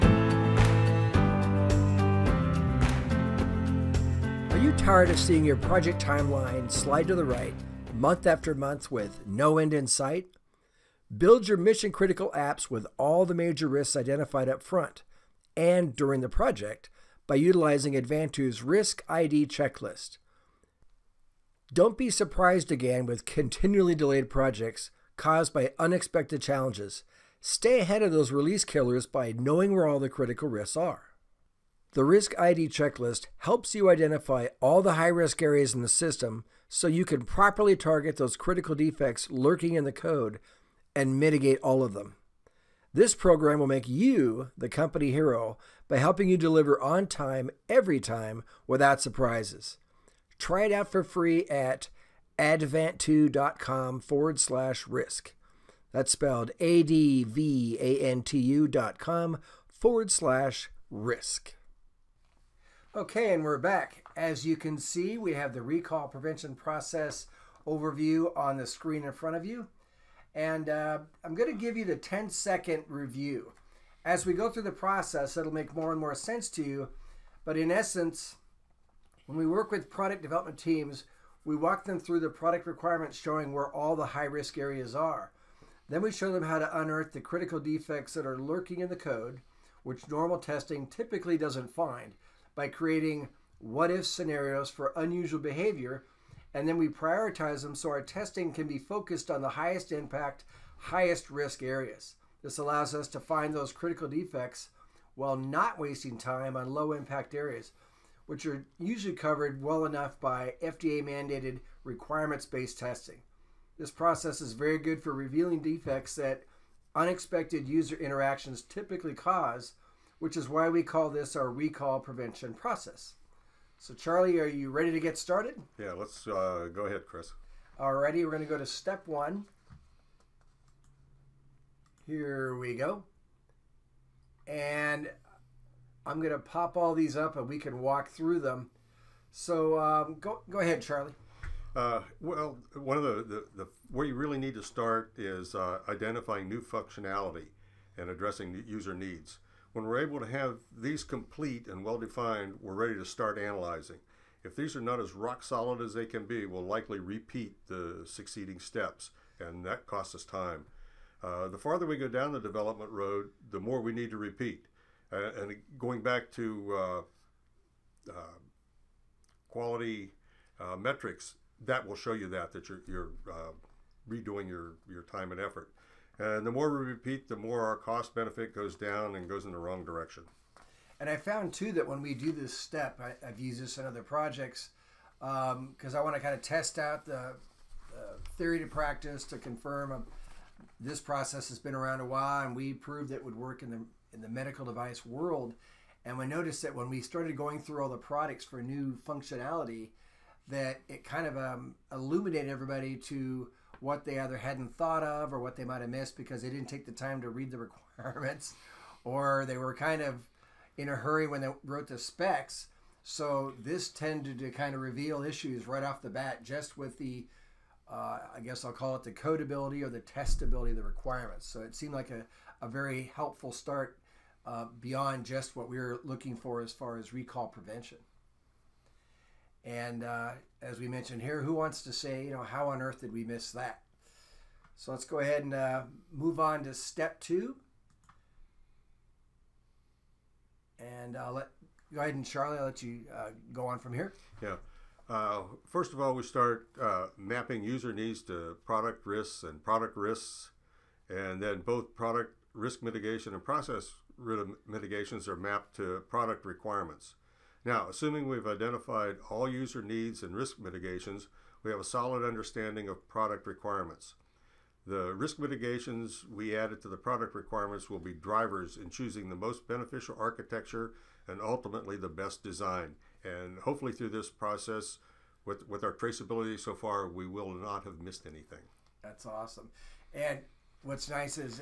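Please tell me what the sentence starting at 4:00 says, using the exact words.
And I'll let, go ahead and Charlie, I'll let you uh, go on from here.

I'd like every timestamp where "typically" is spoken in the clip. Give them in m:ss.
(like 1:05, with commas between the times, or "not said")
1:30, 1:58.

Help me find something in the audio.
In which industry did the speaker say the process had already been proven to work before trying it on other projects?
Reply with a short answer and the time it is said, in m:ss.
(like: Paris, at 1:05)
medical device, at 3:14.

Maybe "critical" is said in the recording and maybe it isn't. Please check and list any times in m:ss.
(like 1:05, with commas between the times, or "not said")
0:11, 0:30, 0:38, 1:27, 1:43.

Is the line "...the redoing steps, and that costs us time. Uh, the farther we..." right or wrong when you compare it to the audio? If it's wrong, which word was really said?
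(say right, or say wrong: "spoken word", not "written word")
wrong: "succeeding", not "redoing".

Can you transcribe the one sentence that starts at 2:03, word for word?
So, Charlie, are you ready to get started?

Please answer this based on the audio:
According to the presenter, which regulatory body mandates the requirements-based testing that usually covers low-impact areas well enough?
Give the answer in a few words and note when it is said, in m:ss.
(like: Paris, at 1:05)
FDA, at 1:50.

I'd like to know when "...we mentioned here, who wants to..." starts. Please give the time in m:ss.
3:50.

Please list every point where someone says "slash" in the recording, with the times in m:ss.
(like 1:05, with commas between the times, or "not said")
0:54, 1:00.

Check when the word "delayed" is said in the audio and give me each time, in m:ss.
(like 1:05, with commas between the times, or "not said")
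0:23.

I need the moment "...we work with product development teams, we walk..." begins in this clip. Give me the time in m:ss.
1:19.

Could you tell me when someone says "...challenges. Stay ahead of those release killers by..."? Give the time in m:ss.
0:26.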